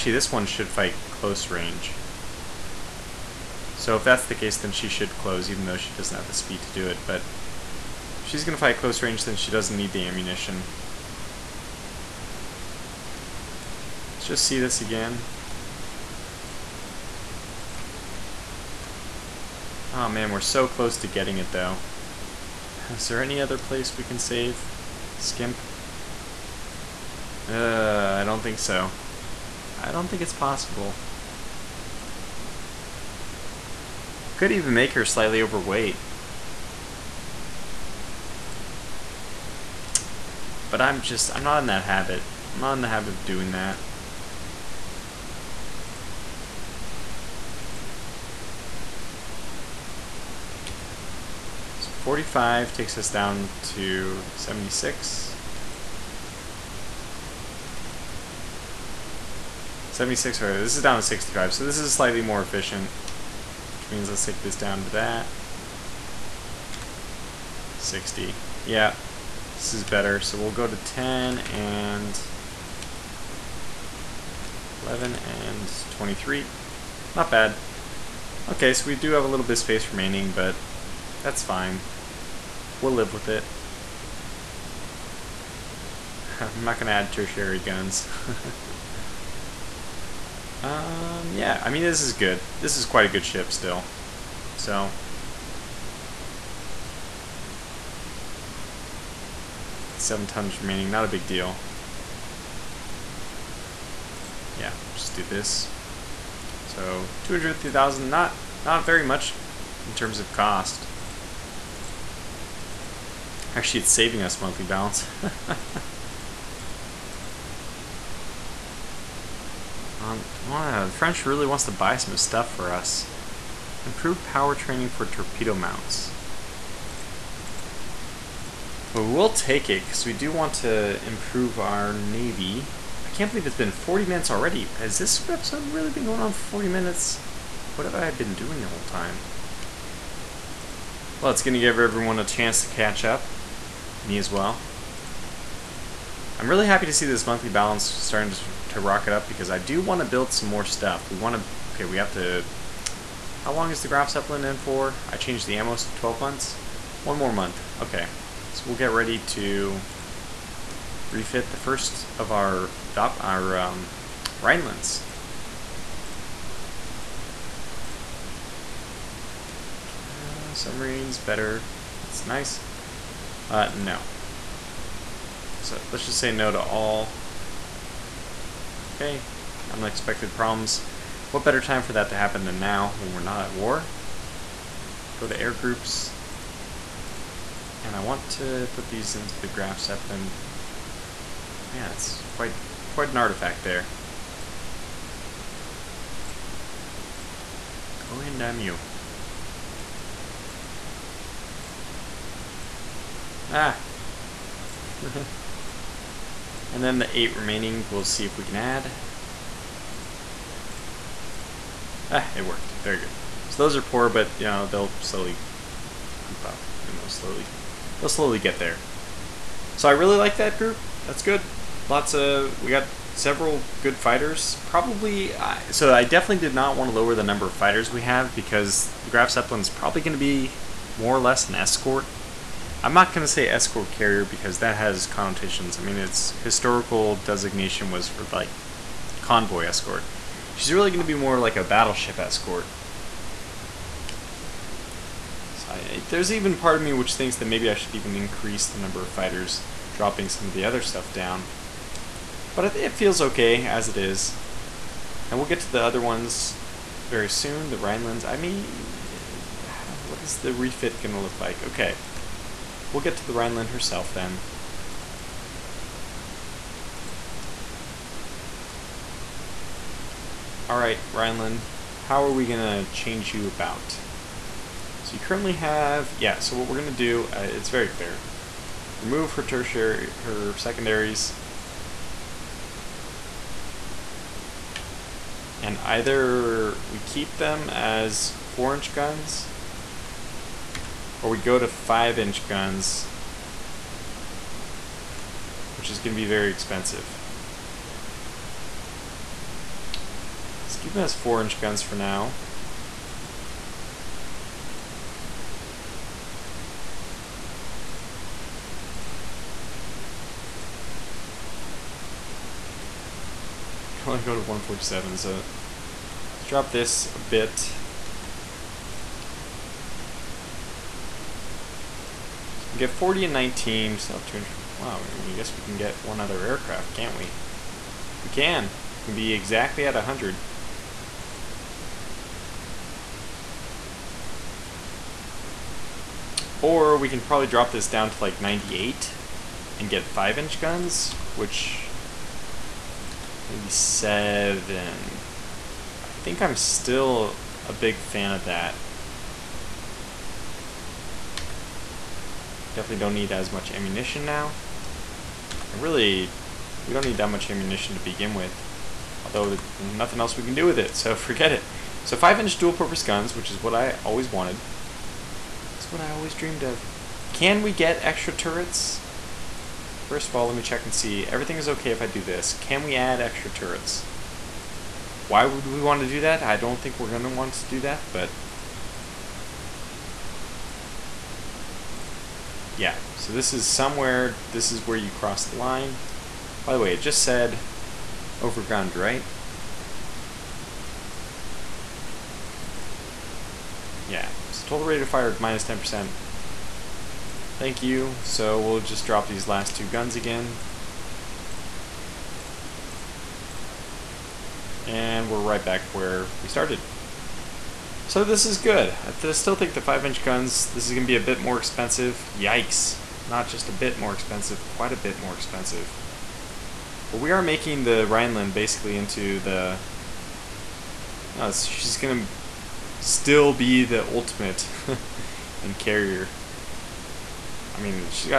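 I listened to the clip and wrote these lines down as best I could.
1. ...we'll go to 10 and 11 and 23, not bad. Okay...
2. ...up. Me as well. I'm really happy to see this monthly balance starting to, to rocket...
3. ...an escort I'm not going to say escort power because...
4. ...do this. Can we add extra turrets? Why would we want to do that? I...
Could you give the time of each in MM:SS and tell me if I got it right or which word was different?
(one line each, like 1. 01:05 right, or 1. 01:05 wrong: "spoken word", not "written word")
1. 01:10 right
2. 02:23 right
3. 03:51 wrong: "carrier", not "power"
4. 06:12 right.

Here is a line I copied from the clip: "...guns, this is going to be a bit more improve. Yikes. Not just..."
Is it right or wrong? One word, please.
wrong.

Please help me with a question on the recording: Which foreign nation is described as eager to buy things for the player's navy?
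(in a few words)
The French.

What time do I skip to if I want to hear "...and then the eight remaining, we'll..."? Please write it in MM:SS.
03:25.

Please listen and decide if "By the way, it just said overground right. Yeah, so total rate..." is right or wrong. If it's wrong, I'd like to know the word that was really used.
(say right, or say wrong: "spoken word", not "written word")
right.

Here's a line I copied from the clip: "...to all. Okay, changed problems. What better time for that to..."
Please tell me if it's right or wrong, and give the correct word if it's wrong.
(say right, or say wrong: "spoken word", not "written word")
wrong: "unexpected", not "changed".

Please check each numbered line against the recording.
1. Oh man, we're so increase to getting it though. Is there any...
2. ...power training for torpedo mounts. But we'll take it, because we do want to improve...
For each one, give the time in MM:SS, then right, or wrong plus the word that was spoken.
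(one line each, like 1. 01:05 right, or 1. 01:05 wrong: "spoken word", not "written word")
1. 00:19 wrong: "close", not "increase"
2. 02:04 right.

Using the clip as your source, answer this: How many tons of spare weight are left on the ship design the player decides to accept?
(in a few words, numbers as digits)
7.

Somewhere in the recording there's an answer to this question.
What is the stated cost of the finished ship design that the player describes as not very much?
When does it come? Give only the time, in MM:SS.
01:47.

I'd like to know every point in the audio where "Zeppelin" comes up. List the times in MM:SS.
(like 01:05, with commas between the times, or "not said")
02:34, 03:09, 03:49.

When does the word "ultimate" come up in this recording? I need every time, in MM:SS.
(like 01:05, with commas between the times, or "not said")
07:04.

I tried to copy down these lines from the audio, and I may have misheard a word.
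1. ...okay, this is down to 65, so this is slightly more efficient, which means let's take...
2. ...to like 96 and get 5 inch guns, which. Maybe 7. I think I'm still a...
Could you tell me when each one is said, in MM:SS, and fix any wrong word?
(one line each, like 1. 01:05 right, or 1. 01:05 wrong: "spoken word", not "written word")
1. 01:00 right
2. 05:38 wrong: "98", not "96".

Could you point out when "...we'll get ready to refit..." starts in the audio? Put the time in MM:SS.
02:38.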